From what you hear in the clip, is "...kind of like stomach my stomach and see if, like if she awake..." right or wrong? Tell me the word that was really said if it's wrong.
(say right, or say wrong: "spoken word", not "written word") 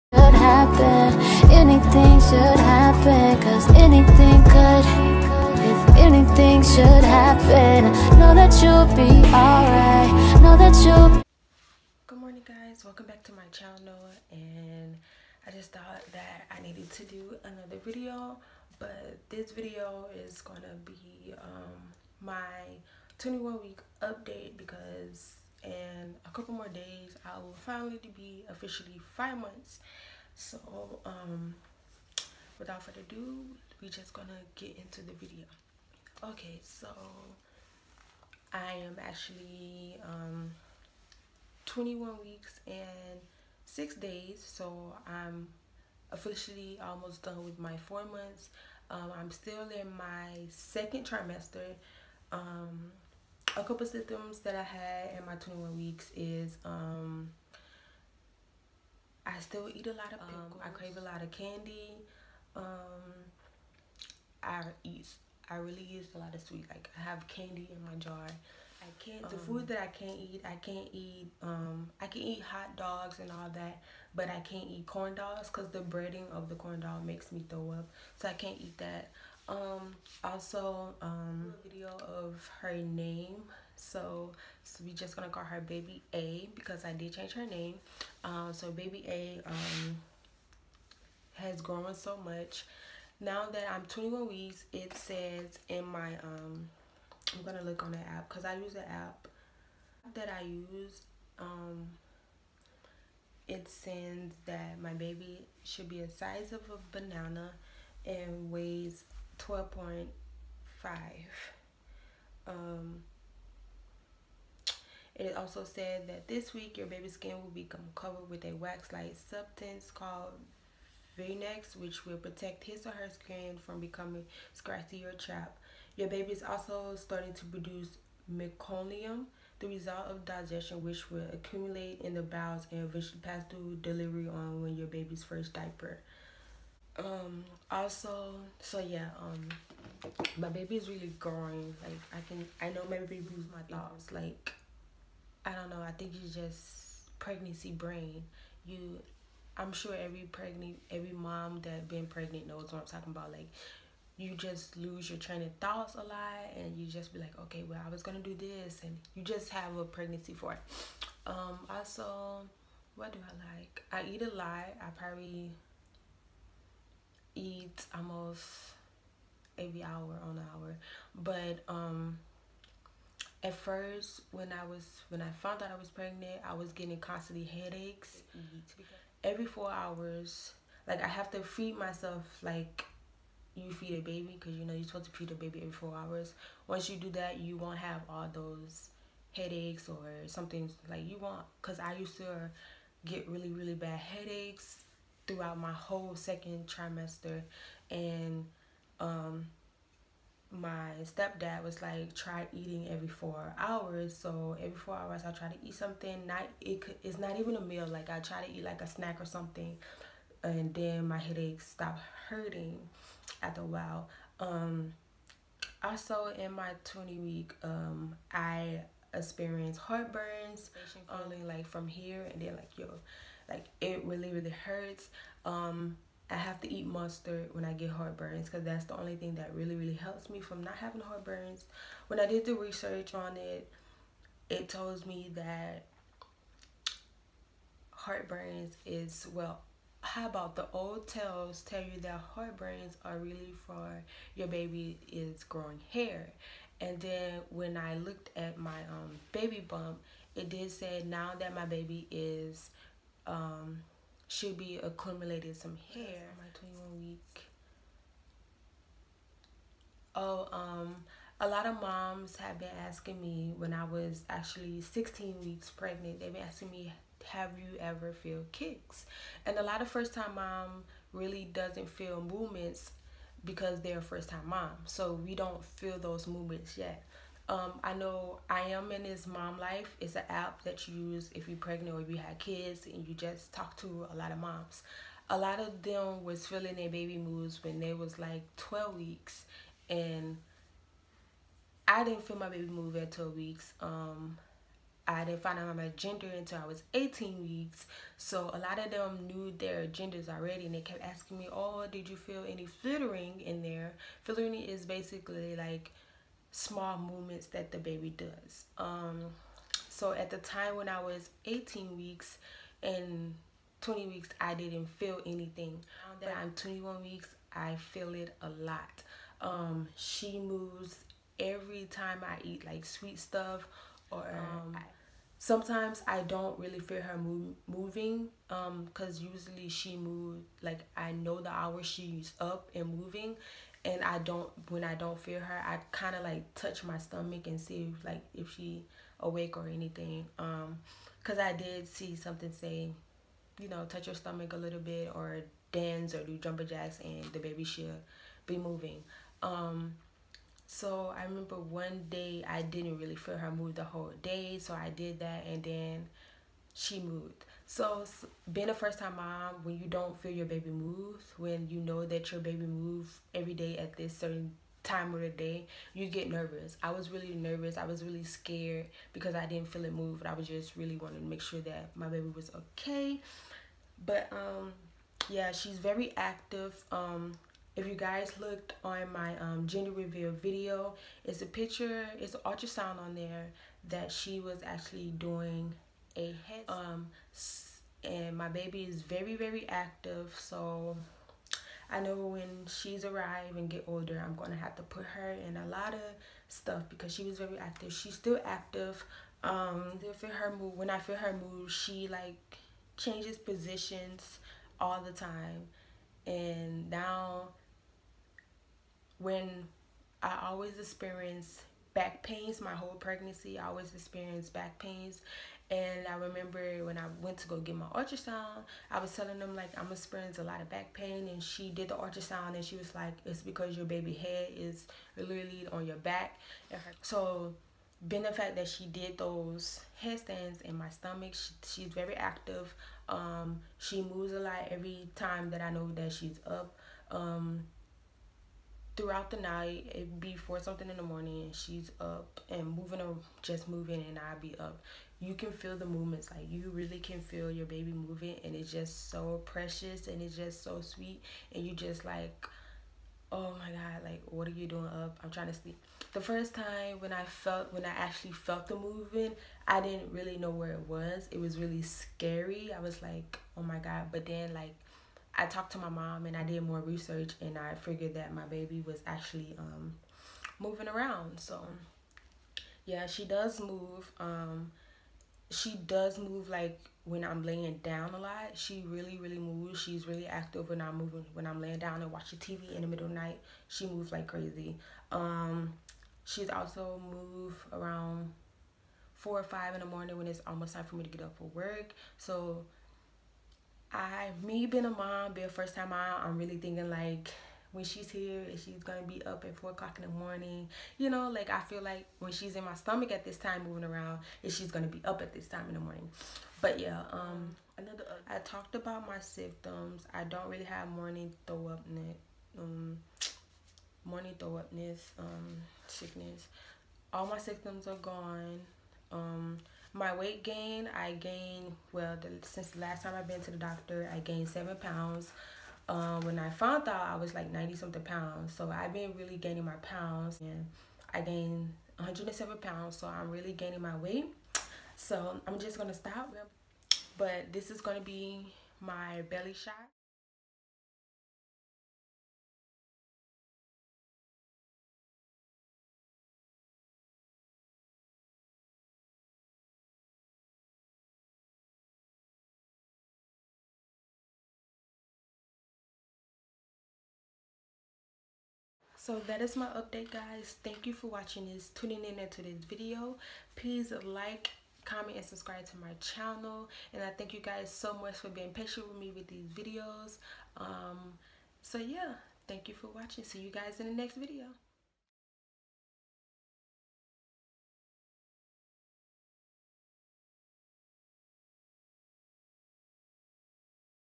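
wrong: "touch", not "stomach".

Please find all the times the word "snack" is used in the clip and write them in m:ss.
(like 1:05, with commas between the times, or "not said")
3:28.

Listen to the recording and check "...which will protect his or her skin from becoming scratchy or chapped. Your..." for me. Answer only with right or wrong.
right.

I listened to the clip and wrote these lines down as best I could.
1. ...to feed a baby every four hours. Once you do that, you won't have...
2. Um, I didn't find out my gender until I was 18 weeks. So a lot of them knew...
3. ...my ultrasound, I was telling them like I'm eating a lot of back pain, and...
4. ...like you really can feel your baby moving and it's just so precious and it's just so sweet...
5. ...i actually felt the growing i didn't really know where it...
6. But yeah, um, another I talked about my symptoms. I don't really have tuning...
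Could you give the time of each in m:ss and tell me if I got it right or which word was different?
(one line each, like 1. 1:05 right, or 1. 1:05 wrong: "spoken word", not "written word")
1. 3:05 right
2. 4:53 right
3. 6:57 wrong: "experiencing", not "eating"
4. 7:26 right
5. 7:37 wrong: "moving", not "growing"
6. 8:26 wrong: "morning", not "tuning".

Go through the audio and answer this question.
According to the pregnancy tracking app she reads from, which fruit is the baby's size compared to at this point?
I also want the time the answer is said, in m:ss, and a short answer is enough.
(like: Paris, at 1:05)
banana, at 1:46.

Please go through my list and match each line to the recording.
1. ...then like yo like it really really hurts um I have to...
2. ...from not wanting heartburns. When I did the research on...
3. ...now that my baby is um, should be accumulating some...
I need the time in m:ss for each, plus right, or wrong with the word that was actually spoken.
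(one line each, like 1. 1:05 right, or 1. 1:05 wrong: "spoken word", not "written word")
1. 3:42 right
2. 3:50 wrong: "having", not "wanting"
3. 4:11 right.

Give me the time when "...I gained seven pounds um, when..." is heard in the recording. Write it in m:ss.
8:44.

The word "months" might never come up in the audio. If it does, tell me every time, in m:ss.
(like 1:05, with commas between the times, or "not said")
0:29, 0:48.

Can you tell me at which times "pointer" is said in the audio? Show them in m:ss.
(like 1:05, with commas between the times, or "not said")
not said.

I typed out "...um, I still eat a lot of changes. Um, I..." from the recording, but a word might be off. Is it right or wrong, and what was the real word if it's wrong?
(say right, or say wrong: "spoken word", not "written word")
wrong: "pickles", not "changes".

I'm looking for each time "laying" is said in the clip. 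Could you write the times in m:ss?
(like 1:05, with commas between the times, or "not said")
7:57, 8:01.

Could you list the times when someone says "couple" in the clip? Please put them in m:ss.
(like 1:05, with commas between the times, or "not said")
0:26, 0:53.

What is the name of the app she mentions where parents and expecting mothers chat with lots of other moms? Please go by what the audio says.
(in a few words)
Mom Life.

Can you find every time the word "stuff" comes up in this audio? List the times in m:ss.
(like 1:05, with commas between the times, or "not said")
5:23, 6:36.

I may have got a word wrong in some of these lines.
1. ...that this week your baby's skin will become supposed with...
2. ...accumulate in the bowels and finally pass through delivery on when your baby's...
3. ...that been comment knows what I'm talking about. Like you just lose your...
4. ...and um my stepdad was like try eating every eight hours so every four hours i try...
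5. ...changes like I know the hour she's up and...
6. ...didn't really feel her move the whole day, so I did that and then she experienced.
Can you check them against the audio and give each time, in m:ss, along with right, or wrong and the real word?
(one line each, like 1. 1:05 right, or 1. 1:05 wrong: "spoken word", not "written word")
1. 1:56 wrong: "covered", not "supposed"
2. 2:11 wrong: "eventually", not "finally"
3. 2:31 wrong: "pregnant", not "comment"
4. 3:17 wrong: "four", not "eight"
5. 5:29 wrong: "moves", not "changes"
6. 5:52 wrong: "moved", not "experienced".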